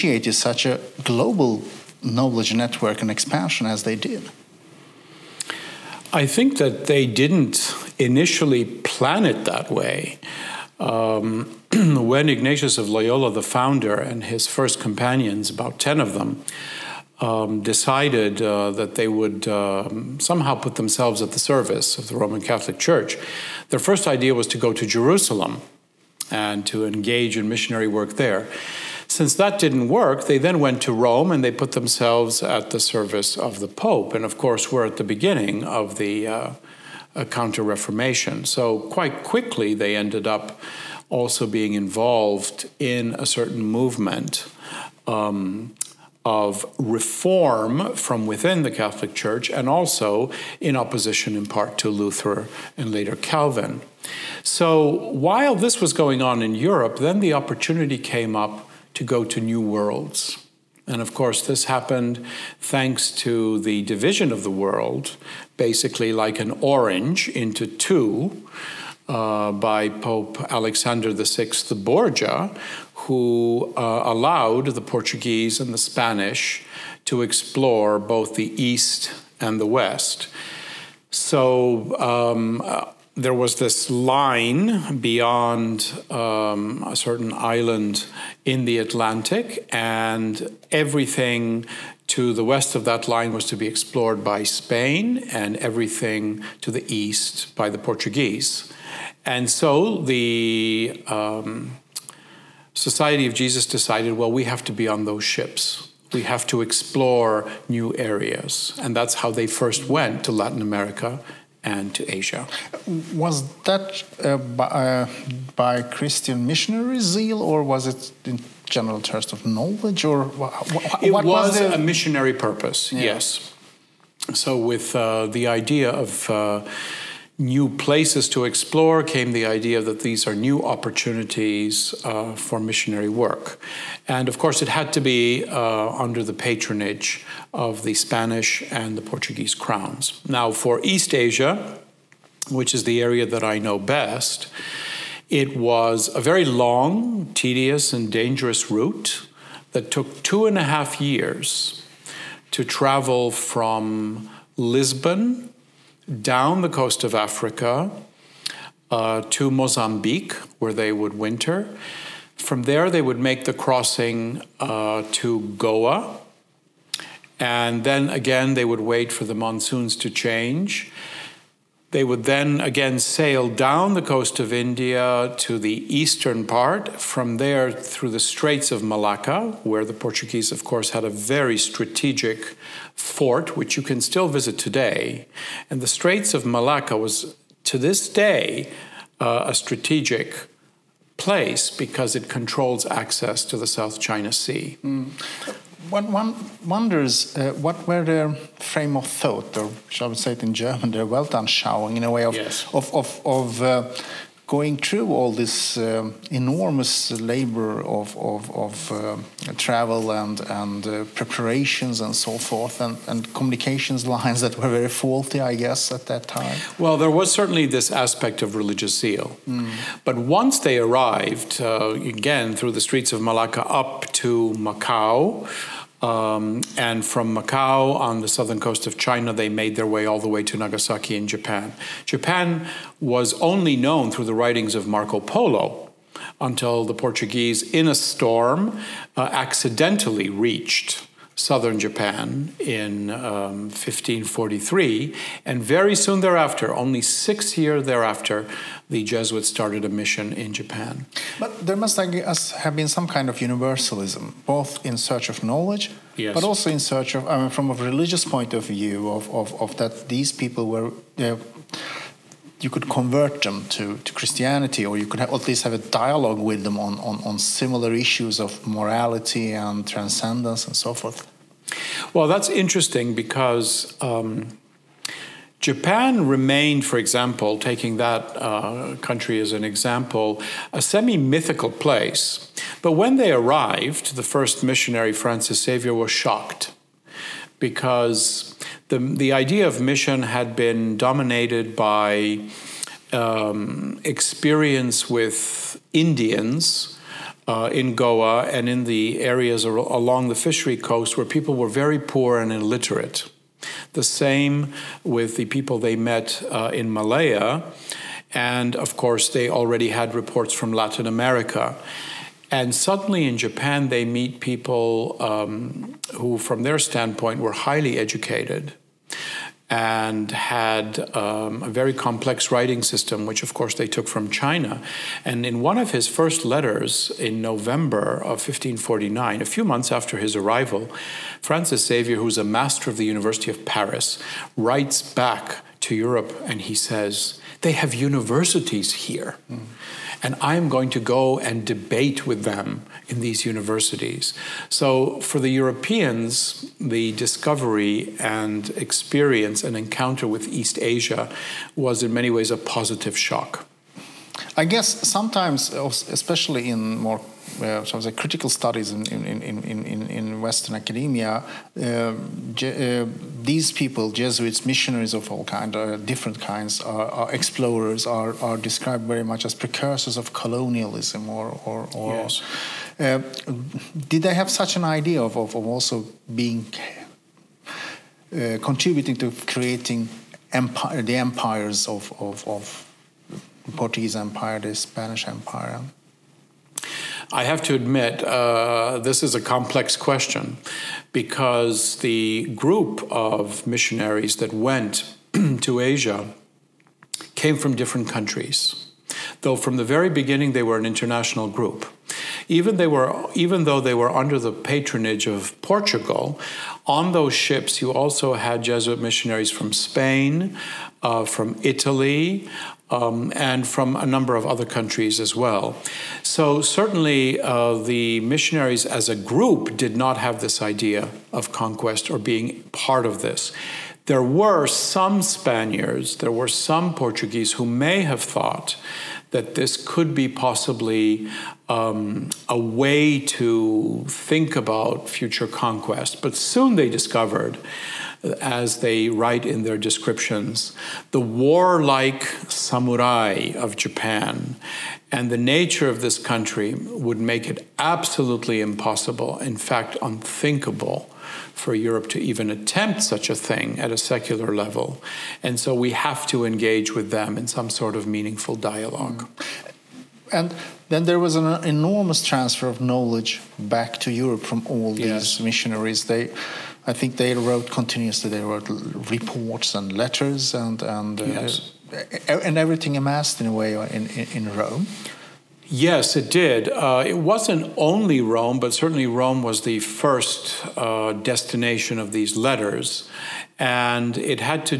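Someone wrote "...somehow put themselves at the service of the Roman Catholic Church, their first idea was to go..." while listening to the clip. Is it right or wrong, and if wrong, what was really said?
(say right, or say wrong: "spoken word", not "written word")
right.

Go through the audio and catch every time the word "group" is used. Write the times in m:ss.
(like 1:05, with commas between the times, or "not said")
6:32, 6:41, 6:59.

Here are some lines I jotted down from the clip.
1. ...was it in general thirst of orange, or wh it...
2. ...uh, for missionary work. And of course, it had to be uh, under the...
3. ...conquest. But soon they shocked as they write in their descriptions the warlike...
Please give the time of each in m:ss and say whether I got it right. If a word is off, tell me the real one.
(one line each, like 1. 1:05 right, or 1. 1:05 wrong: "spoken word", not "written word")
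1. 1:57 wrong: "knowledge", not "orange"
2. 2:12 right
3. 7:15 wrong: "discovered", not "shocked".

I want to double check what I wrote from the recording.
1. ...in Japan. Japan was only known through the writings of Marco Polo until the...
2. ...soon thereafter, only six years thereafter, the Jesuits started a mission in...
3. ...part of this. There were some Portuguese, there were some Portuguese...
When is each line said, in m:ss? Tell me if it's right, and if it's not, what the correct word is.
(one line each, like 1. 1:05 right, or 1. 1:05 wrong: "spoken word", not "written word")
1. 3:51 right
2. 4:05 right
3. 7:02 wrong: "Spaniards", not "Portuguese".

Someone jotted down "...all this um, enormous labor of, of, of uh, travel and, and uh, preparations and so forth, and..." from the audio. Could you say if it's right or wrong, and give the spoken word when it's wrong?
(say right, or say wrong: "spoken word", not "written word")
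right.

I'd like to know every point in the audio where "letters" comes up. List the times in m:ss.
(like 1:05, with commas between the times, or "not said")
5:26, 7:49, 8:02.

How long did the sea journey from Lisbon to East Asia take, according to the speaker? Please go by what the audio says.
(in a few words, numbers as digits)
2 and a half years.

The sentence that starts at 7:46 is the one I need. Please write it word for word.
They I think they wrote continuously.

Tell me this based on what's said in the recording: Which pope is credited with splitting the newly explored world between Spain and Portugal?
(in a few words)
Alexander VI Borgia.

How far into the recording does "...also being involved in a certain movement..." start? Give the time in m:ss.
0:41.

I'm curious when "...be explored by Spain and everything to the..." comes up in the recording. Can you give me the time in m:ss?
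1:33.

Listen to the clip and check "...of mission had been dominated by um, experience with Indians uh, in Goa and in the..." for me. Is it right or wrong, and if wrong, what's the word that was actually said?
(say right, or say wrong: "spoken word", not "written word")
right.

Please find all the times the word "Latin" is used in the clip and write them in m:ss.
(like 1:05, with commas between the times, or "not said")
1:50, 5:10.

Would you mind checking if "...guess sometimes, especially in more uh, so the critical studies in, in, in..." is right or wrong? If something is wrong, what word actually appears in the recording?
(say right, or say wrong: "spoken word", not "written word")
right.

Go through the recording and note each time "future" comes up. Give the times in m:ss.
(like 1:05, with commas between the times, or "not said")
7:15.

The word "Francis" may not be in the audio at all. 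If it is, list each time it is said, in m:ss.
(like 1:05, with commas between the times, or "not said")
4:45, 5:31.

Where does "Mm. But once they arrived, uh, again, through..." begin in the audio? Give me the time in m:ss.
3:39.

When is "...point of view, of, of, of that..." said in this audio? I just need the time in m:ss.
4:18.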